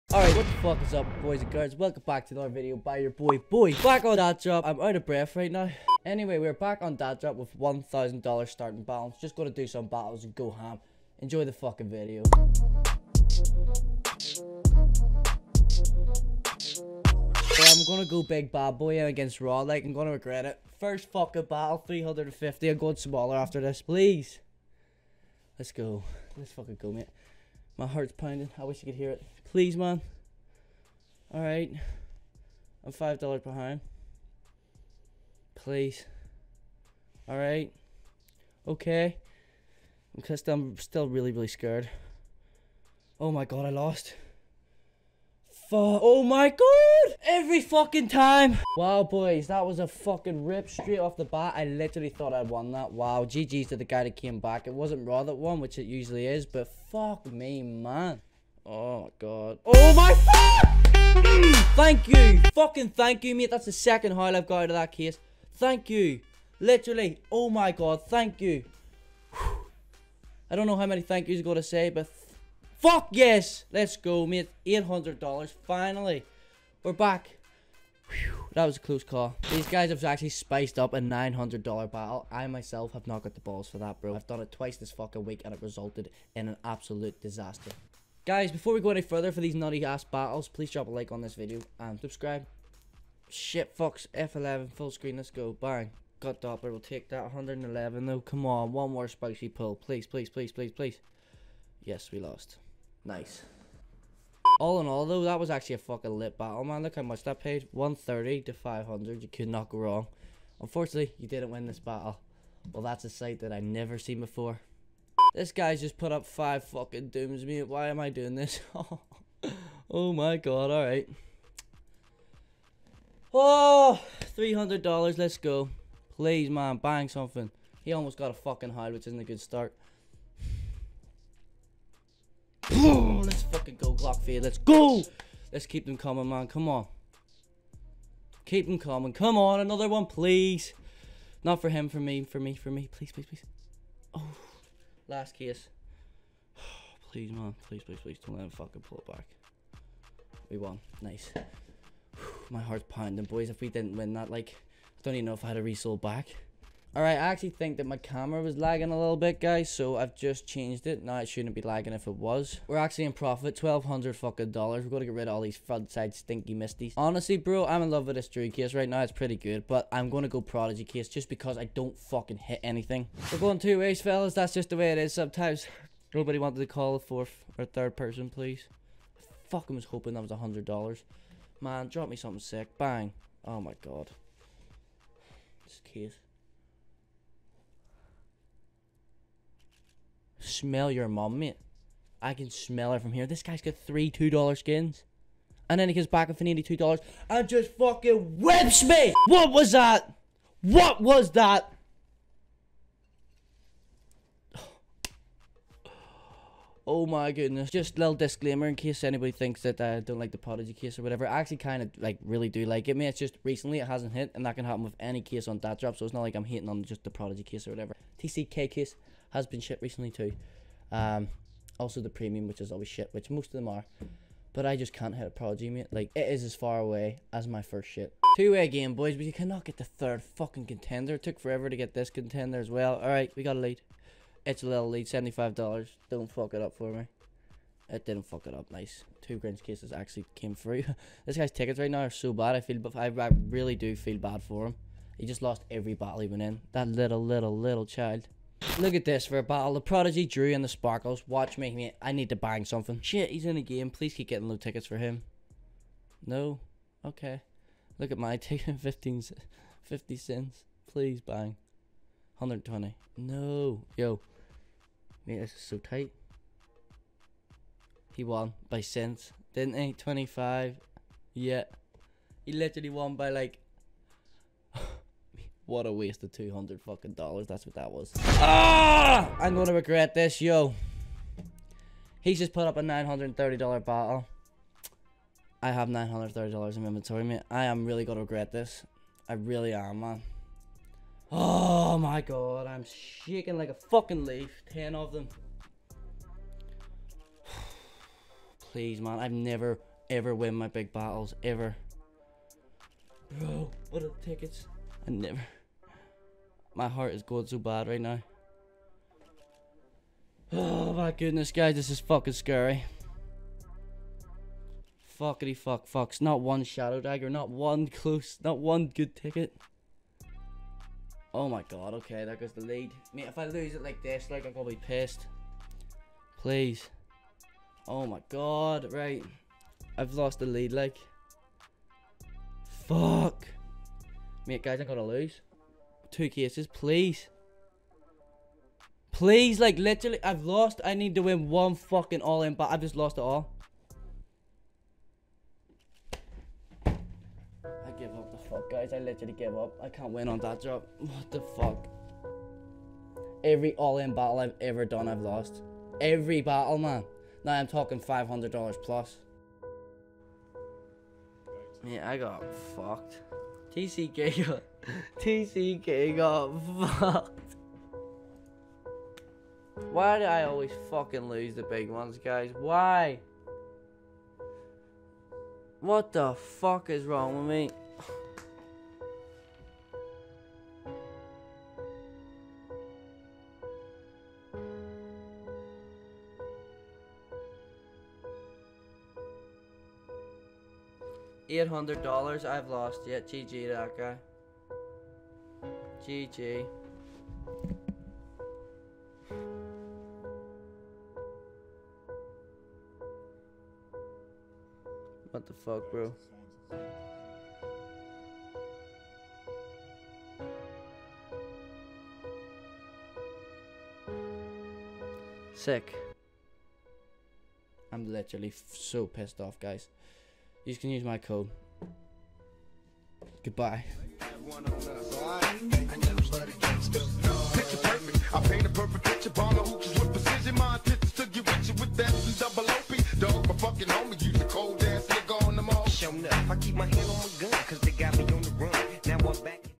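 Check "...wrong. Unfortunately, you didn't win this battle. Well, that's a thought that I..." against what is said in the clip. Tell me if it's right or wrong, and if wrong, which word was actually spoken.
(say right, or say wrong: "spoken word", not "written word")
wrong: "sight", not "thought".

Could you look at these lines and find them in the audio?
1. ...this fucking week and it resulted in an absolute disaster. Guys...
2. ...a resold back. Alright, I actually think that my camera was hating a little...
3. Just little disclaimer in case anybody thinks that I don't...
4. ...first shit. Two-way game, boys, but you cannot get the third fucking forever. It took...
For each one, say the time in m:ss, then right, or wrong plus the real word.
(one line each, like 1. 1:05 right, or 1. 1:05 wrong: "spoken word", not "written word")
1. 1:24 right
2. 2:35 wrong: "lagging", not "hating"
3. 3:27 right
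4. 3:47 wrong: "contender", not "forever".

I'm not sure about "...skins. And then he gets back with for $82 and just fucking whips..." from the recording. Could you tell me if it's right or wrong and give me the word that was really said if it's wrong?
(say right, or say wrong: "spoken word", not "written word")
right.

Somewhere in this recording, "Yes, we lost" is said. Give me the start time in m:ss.
1:41.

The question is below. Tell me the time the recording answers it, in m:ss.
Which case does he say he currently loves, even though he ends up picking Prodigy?
2:48.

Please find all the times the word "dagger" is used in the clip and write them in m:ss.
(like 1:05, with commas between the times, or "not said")
5:16.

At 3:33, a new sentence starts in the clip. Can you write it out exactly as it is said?
It's just recently it hasn't hit and that can happen with any case on Datdrop.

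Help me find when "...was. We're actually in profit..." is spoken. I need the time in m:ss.
2:42.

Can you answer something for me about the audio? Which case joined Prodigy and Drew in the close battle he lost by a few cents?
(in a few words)
Sparkles.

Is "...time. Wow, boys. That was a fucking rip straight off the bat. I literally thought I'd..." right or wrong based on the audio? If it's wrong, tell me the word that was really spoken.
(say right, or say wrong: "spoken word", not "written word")
right.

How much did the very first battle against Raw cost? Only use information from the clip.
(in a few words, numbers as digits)
350.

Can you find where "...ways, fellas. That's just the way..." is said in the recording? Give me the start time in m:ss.
2:53.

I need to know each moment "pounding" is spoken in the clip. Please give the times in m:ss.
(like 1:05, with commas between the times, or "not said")
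0:28, 2:32.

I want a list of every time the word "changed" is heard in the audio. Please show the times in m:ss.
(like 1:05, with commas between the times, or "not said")
2:40.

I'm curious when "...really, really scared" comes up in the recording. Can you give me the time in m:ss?
0:41.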